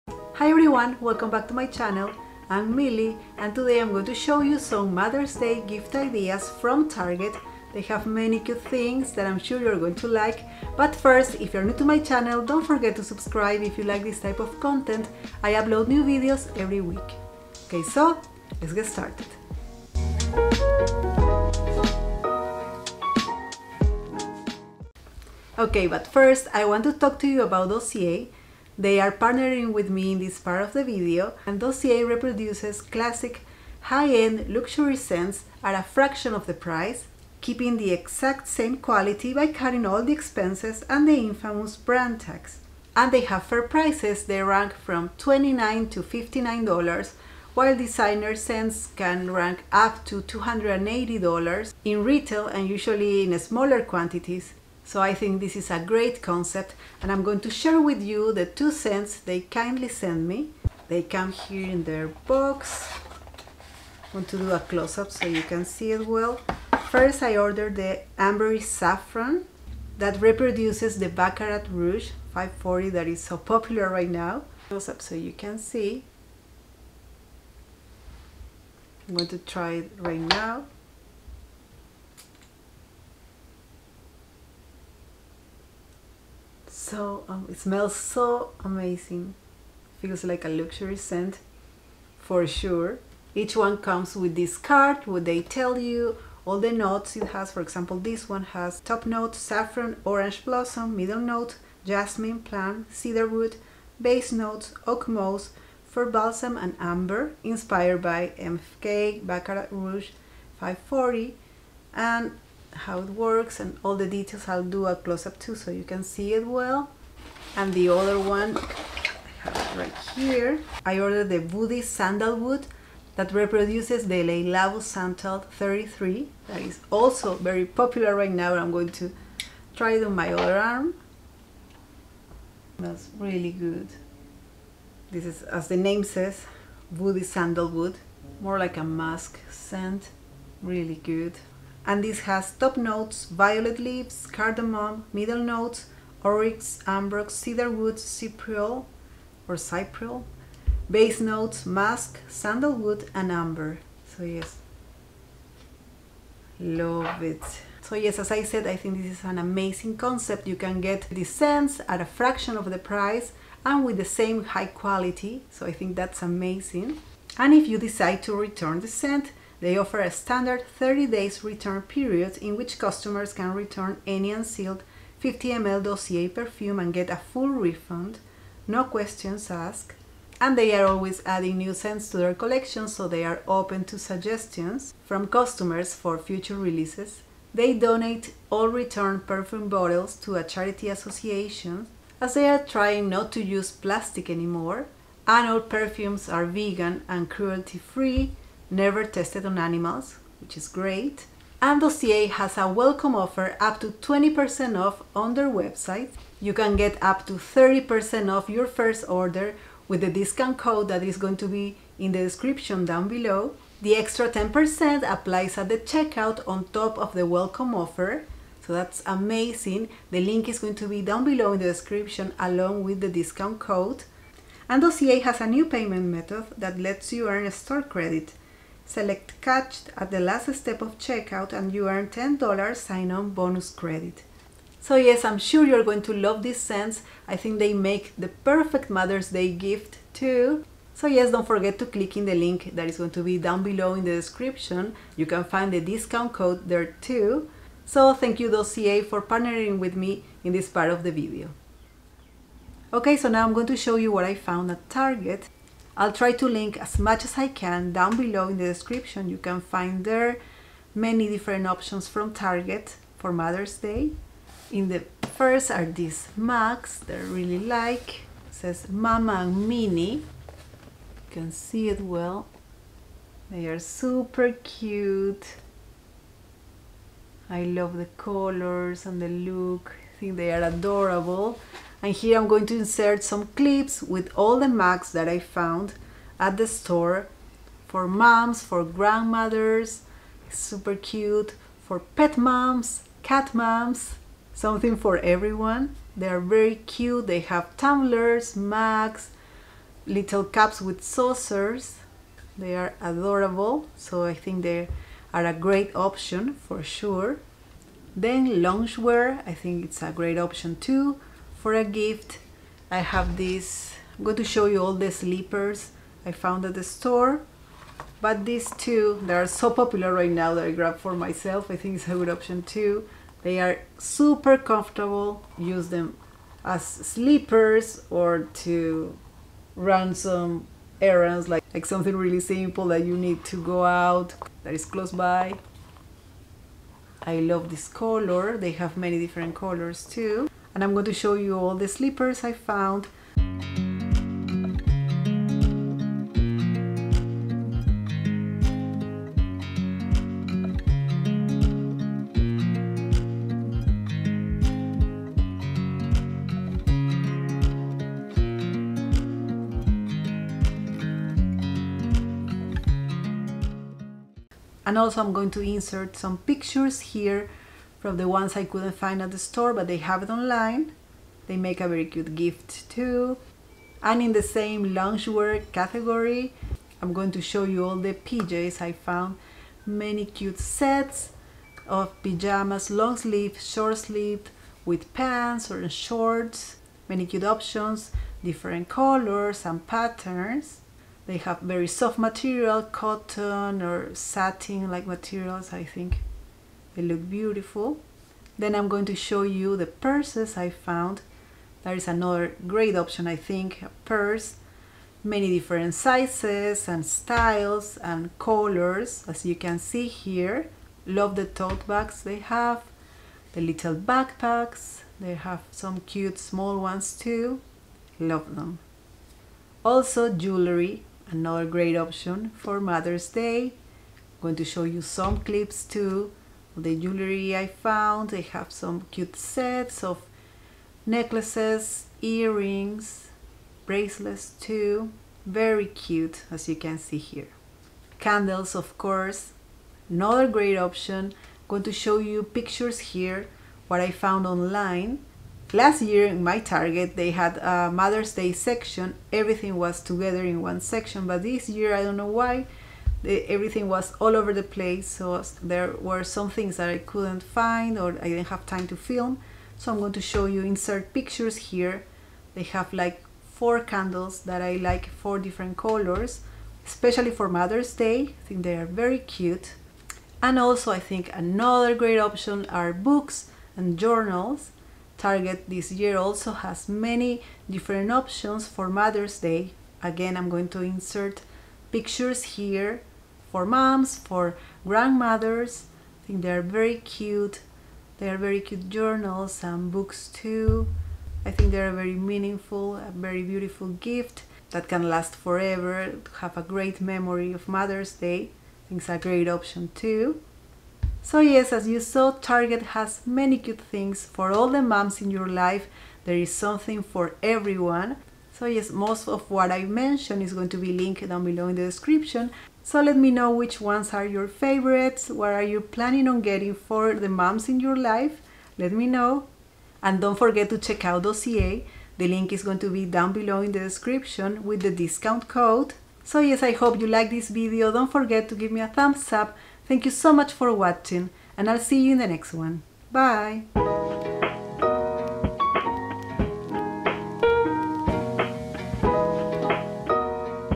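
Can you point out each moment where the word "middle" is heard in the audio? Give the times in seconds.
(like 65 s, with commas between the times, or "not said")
100 s, 145 s.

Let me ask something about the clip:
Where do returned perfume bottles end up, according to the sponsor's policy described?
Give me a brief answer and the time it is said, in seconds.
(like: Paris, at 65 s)
a charity association, at 190 s.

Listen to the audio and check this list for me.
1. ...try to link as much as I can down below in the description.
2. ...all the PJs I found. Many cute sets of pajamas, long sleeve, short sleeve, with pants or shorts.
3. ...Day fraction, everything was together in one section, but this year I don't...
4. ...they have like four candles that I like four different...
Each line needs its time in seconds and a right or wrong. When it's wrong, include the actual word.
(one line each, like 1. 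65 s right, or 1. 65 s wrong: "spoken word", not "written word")
1. 256 s right
2. 377 s right
3. 448 s wrong: "section", not "fraction"
4. 462 s right.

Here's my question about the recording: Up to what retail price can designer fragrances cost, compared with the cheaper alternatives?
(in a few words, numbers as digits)
$280.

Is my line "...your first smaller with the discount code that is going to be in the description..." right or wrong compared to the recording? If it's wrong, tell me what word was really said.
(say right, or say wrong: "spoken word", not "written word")
wrong: "order", not "smaller".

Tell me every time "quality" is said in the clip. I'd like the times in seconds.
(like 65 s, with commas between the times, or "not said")
38 s, 164 s.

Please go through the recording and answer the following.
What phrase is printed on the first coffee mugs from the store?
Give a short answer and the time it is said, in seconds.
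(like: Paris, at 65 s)
Mama Mini, at 268 s.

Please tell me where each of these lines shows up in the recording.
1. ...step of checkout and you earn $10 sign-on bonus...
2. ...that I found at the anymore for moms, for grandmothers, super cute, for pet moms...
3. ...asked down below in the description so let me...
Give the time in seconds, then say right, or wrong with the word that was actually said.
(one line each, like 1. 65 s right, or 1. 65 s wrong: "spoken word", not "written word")
1. 230 s right
2. 285 s wrong: "store", not "anymore"
3. 510 s wrong: "linked", not "asked".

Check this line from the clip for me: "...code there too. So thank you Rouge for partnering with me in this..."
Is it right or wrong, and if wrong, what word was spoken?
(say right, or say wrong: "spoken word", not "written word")
wrong: "Dossier", not "Rouge".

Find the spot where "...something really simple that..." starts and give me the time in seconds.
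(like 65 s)
331 s.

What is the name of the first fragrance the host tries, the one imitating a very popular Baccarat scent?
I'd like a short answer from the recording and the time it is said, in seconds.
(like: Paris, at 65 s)
Ambery Saffron, at 68 s.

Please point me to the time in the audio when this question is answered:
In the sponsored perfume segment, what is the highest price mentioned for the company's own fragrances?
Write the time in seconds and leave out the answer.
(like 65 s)
46 s.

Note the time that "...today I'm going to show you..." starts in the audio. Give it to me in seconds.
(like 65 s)
3 s.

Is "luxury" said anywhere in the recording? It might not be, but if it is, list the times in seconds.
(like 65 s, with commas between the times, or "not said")
34 s, 90 s.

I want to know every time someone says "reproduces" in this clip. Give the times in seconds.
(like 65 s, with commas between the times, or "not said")
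32 s, 70 s, 123 s.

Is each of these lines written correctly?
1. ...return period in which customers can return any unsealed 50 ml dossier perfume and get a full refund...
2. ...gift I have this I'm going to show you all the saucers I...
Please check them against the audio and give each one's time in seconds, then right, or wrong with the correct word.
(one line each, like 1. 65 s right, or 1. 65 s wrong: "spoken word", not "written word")
1. 171 s right
2. 311 s wrong: "slippers", not "saucers".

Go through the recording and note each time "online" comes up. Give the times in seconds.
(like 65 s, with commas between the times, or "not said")
370 s, 444 s.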